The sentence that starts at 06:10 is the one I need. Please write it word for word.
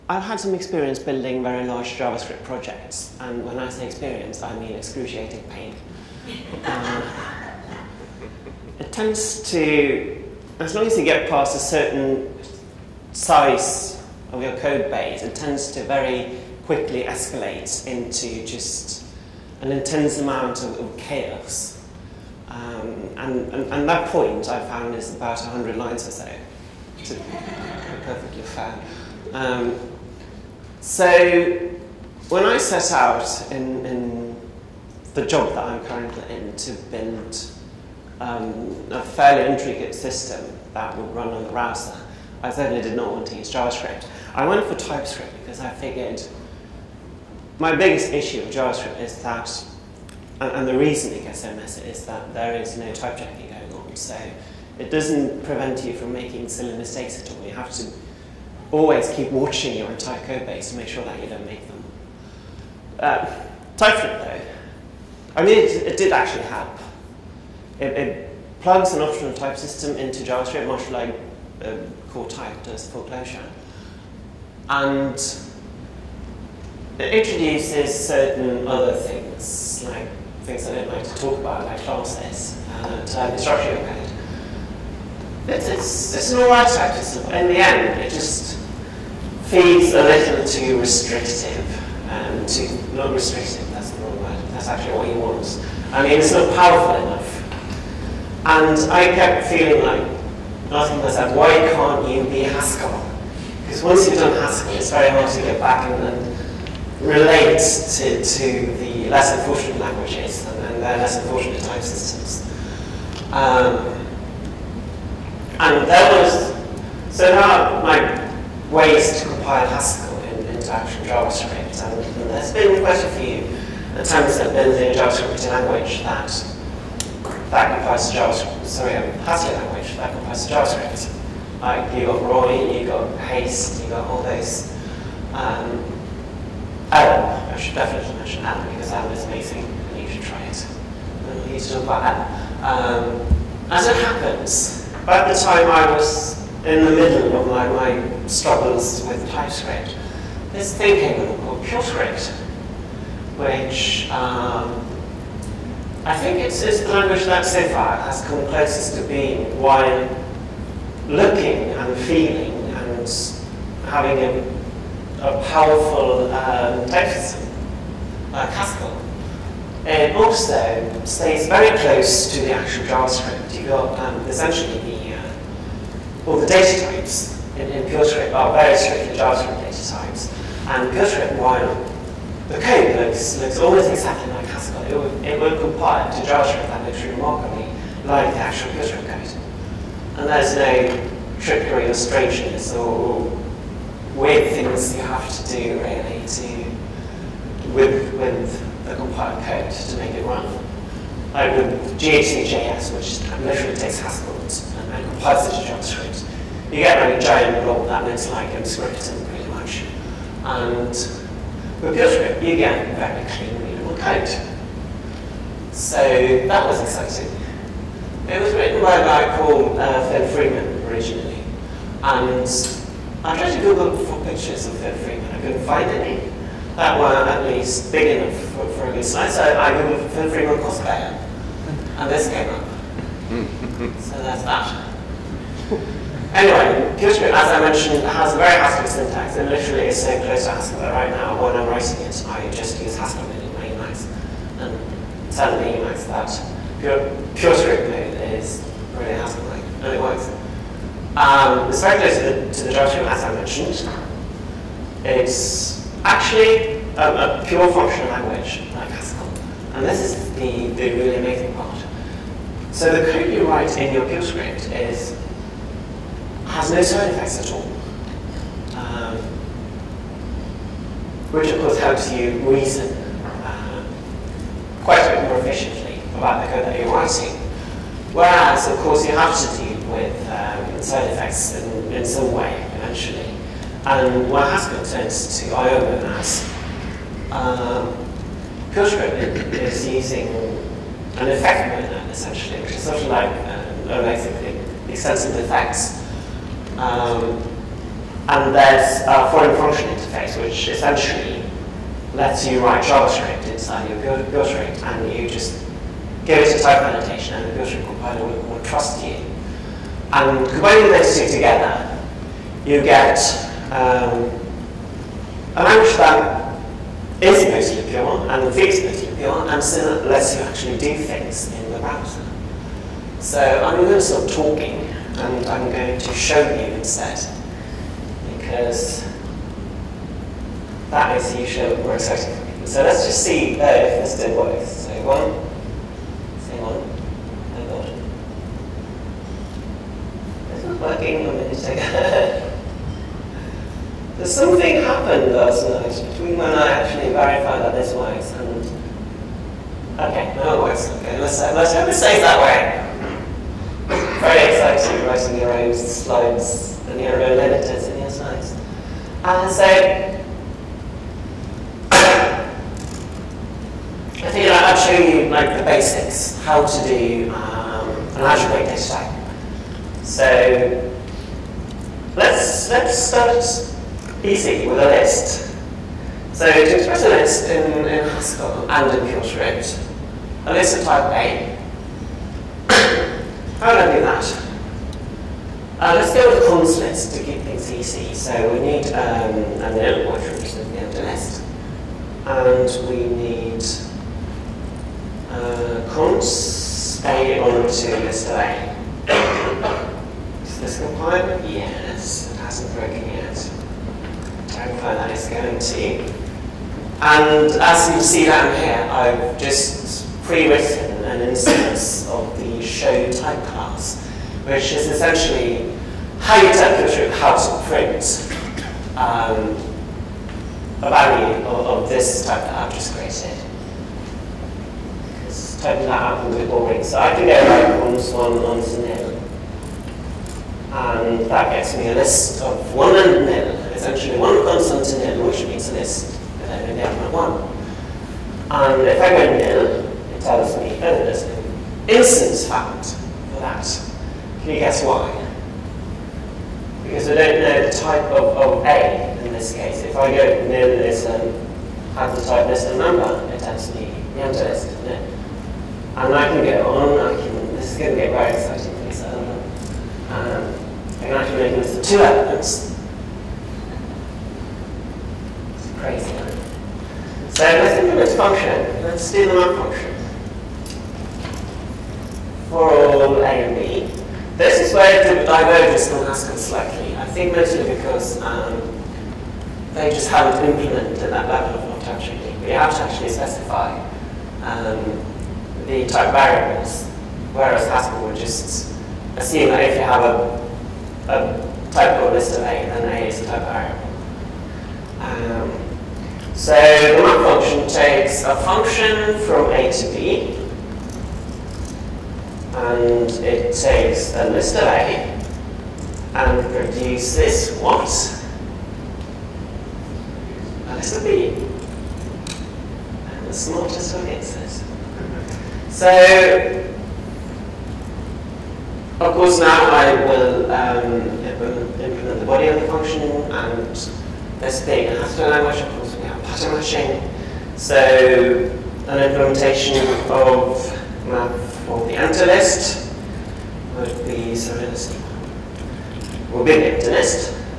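So let's let's start BC with a list.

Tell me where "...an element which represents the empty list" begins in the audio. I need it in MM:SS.
06:29.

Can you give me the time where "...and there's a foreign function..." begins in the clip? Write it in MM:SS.
04:58.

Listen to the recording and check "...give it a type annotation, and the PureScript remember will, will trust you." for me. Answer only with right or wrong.
wrong.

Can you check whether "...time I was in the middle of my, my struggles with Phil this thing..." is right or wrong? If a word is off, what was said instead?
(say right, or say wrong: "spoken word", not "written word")
wrong: "TypeScript", not "Phil".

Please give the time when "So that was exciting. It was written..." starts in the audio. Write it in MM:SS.
03:35.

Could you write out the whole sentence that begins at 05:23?
So I'm going to stop talking and I'm going to show you instead because that is usually more exciting for people.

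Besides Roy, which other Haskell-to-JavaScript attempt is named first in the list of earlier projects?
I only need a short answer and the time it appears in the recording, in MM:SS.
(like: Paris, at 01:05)
Haste, at 02:13.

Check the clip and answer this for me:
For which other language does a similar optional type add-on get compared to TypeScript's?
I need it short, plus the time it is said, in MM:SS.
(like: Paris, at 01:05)
Clojure, at 01:13.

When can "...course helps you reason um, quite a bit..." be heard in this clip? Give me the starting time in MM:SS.
04:31.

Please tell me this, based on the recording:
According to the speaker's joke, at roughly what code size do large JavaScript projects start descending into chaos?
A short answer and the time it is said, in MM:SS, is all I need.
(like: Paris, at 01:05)
100 lines, at 00:25.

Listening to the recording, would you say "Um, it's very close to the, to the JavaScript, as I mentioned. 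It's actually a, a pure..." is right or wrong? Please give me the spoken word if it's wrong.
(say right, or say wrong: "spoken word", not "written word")
right.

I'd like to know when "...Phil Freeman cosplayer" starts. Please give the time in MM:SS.
03:50.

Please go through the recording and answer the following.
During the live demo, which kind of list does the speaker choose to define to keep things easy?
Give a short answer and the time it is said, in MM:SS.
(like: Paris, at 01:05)
cons list, at 06:26.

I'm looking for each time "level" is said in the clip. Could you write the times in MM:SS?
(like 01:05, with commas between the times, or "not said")
08:01.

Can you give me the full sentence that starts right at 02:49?
It also stays very close to the actual JavaScript.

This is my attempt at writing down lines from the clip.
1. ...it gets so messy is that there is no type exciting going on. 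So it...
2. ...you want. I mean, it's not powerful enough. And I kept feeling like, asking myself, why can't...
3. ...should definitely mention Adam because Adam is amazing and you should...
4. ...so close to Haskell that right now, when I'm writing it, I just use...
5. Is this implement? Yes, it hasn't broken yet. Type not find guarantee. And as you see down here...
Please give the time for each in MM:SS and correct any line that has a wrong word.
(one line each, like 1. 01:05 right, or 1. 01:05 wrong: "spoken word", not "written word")
1. 00:51 wrong: "checking", not "exciting"
2. 01:35 right
3. 02:17 right
4. 04:00 right
5. 06:40 wrong: "compliant", not "implement".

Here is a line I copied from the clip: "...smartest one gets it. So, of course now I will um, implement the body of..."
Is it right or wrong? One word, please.
right.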